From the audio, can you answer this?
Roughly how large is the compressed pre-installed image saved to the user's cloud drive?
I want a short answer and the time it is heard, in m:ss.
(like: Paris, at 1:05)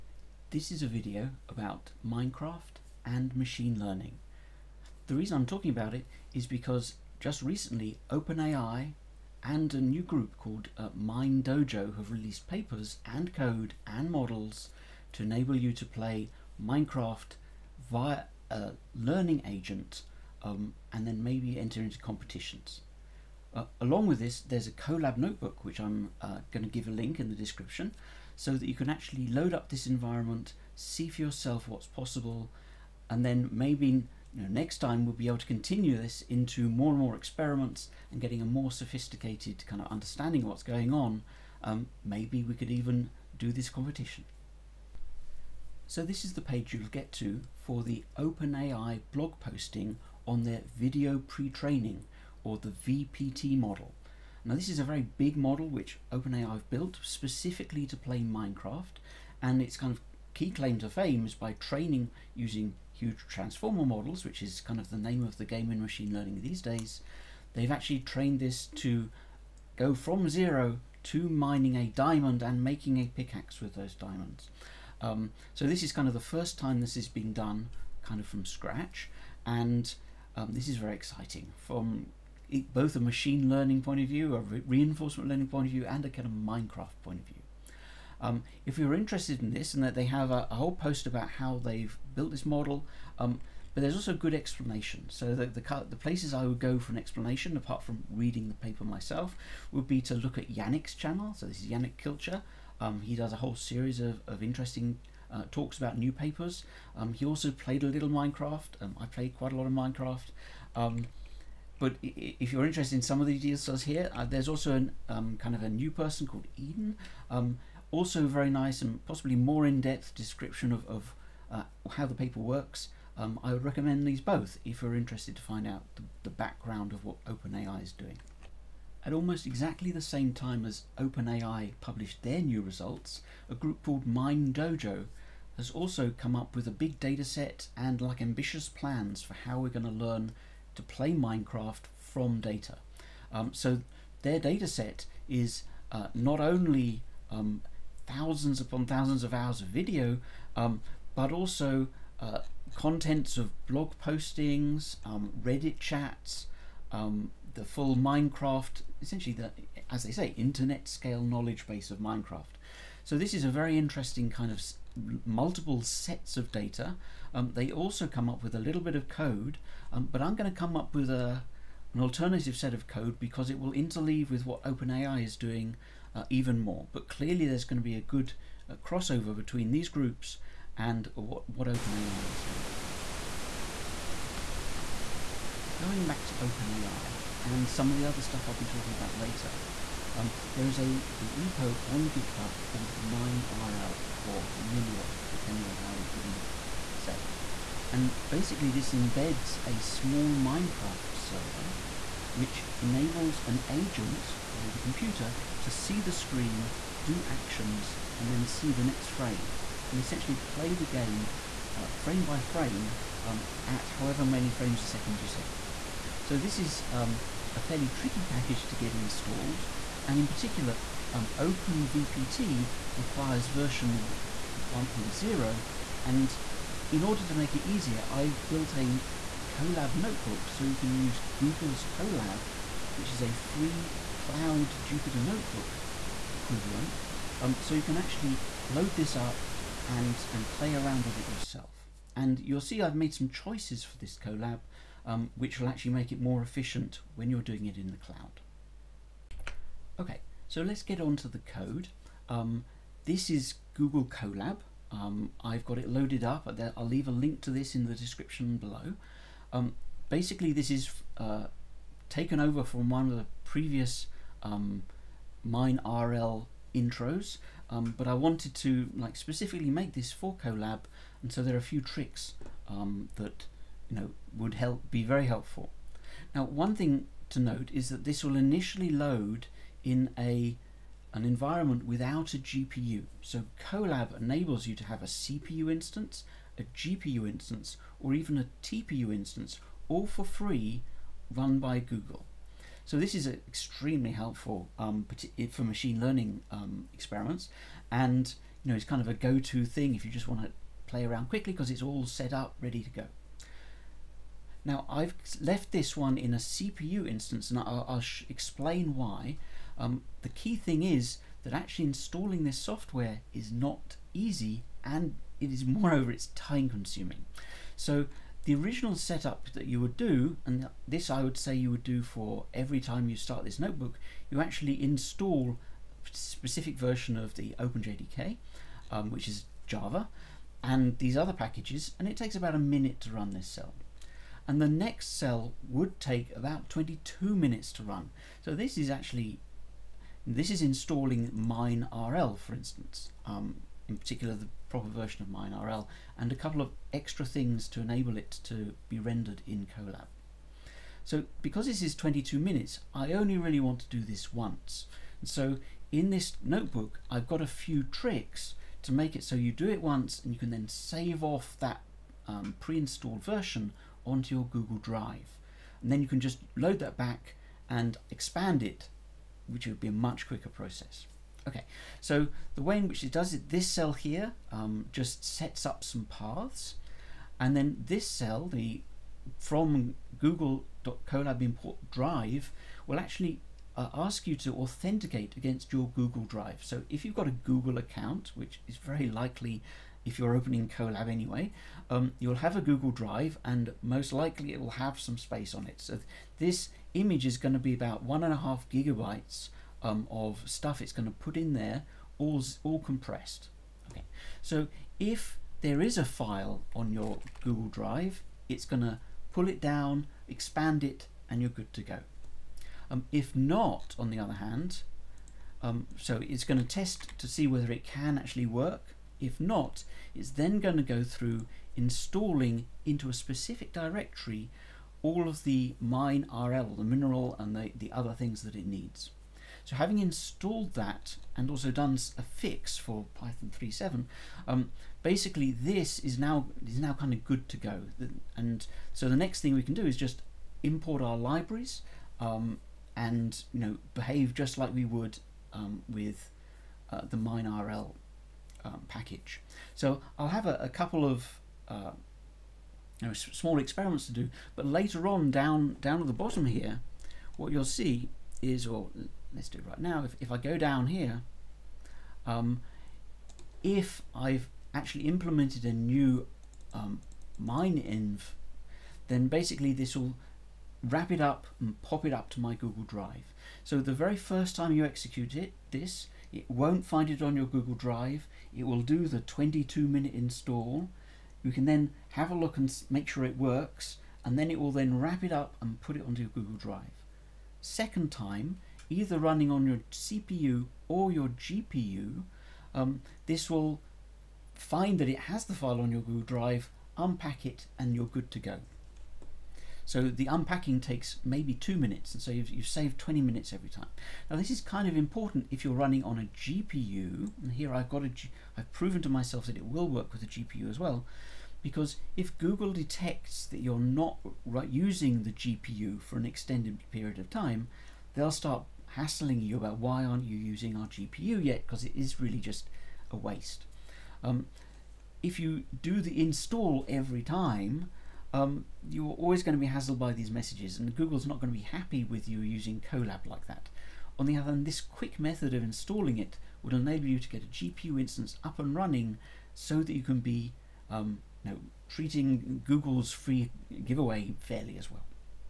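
1.5 gigabytes, at 6:38.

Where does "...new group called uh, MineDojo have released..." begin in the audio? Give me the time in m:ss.
0:09.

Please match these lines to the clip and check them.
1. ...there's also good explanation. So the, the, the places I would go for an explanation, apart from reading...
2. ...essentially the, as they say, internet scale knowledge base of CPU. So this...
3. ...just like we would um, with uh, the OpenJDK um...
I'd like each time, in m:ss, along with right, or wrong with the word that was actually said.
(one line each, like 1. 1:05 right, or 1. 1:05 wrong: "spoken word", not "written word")
1. 1:33 right
2. 2:39 wrong: "Minecraft", not "CPU"
3. 7:24 wrong: "MineRL", not "OpenJDK".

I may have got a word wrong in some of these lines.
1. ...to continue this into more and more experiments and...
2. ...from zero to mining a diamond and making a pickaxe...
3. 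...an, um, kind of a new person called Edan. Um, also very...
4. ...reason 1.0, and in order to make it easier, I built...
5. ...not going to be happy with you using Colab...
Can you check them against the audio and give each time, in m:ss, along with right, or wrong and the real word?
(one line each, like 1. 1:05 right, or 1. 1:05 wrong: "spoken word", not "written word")
1. 0:35 right
2. 1:09 right
3. 1:54 right
4. 3:43 wrong: "version", not "reason"
5. 8:51 right.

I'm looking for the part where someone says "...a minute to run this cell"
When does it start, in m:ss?
5:32.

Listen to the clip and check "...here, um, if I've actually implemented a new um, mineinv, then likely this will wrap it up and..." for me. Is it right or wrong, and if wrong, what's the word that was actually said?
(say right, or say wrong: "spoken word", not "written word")
wrong: "basically", not "likely".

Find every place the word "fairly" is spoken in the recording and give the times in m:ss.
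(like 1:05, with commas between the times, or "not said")
3:37, 9:04.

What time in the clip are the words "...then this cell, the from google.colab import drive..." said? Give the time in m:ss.
6:17.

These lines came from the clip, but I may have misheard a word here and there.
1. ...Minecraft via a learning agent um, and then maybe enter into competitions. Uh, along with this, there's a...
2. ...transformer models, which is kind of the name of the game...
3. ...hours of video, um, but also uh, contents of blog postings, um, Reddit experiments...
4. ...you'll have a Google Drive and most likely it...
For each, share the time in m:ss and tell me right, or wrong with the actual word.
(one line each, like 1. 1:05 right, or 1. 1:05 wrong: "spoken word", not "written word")
1. 0:16 right
2. 1:03 right
3. 2:29 wrong: "chats", not "experiments"
4. 6:32 right.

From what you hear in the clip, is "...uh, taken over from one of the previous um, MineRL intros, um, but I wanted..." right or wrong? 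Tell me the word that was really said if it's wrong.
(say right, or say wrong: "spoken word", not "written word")
right.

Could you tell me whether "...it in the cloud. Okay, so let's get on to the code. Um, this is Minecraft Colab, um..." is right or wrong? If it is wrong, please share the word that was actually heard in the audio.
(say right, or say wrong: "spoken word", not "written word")
wrong: "Google", not "Minecraft".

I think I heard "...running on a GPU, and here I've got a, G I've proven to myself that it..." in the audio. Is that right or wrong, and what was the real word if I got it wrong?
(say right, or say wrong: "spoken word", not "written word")
right.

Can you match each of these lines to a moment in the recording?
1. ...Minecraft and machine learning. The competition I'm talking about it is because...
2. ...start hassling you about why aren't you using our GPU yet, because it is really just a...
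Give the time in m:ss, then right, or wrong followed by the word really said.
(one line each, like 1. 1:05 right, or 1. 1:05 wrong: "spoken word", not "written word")
1. 0:02 wrong: "reason", not "competition"
2. 8:38 right.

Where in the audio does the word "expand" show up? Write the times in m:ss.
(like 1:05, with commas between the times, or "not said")
6:08, 6:50.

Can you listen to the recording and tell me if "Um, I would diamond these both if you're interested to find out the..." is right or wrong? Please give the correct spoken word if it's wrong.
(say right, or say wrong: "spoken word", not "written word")
wrong: "recommend", not "diamond".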